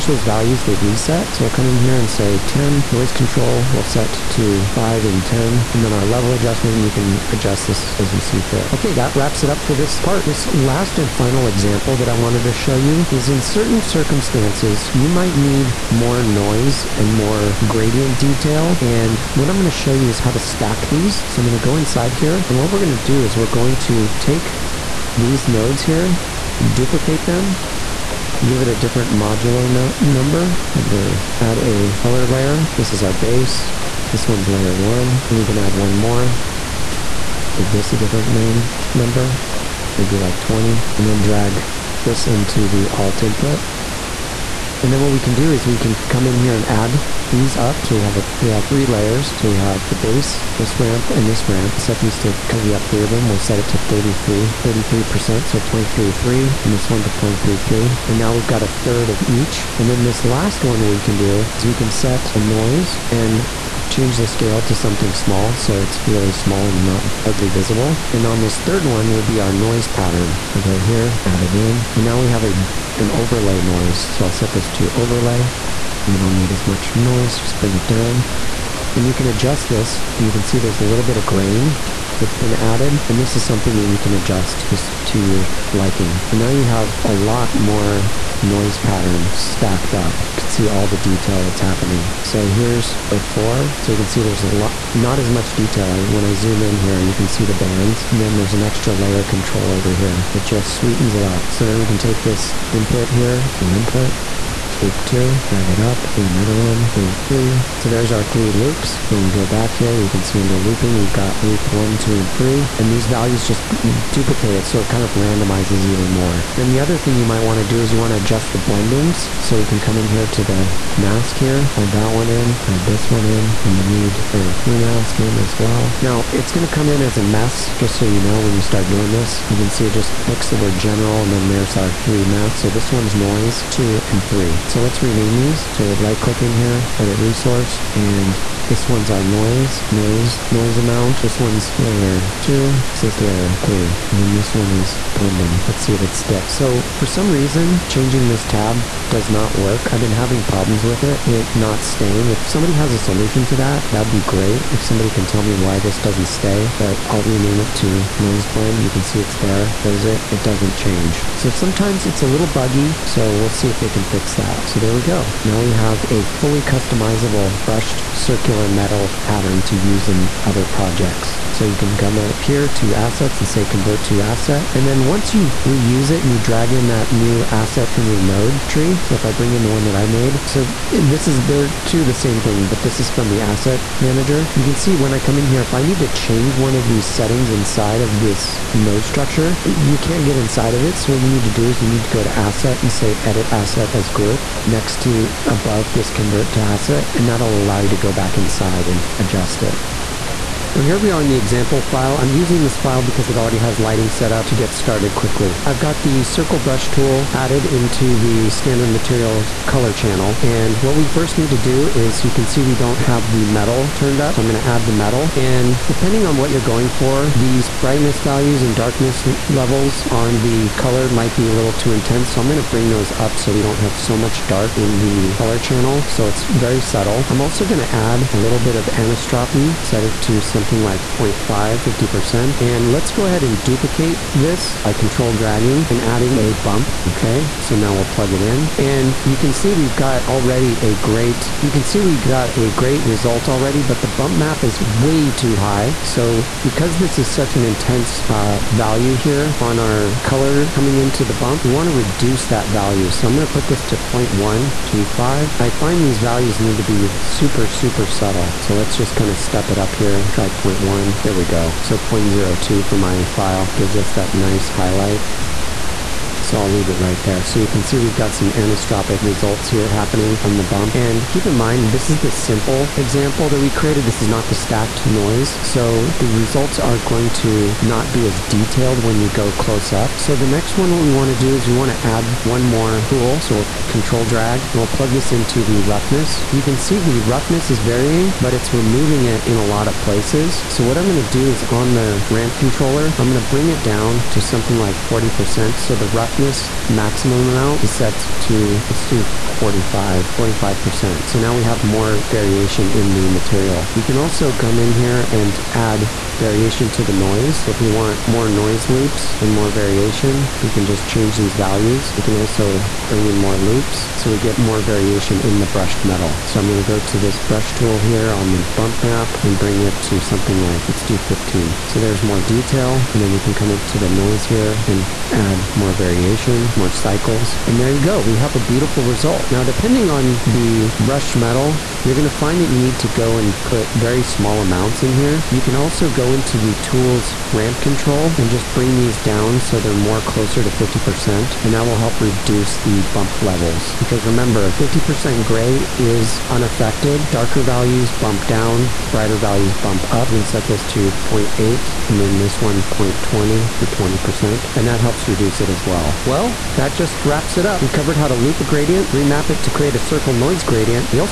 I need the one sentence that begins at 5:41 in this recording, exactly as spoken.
And that will help reduce the bump levels.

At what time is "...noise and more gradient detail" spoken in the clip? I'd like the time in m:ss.
0:16.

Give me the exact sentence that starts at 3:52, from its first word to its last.
And let's go ahead and duplicate this by control dragging and adding a bump.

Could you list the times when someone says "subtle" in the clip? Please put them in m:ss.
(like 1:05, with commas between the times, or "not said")
3:46, 4:18.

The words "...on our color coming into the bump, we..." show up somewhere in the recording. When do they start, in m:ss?
4:09.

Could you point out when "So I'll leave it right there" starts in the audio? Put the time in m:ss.
4:26.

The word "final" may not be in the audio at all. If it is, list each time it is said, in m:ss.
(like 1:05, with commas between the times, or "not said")
0:11.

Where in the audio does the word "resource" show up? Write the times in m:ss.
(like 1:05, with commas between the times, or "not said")
2:17.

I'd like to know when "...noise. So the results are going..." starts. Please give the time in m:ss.
4:35.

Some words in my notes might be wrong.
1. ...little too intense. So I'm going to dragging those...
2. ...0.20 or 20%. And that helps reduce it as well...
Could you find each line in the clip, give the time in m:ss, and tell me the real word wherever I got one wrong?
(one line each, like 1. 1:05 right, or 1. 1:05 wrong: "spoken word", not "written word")
1. 3:41 wrong: "bring", not "dragging"
2. 5:52 right.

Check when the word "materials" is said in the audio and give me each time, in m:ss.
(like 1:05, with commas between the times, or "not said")
3:28, 5:03.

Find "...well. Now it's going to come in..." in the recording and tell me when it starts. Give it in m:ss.
2:05.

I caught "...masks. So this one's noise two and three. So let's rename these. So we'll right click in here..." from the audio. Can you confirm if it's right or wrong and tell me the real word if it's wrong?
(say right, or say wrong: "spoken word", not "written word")
right.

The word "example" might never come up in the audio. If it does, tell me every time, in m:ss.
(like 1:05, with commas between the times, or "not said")
0:11, 3:21, 4:32.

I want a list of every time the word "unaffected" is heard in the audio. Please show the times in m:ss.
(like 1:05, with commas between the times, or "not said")
5:46.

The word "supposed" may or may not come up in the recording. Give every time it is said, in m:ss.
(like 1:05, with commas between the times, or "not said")
not said.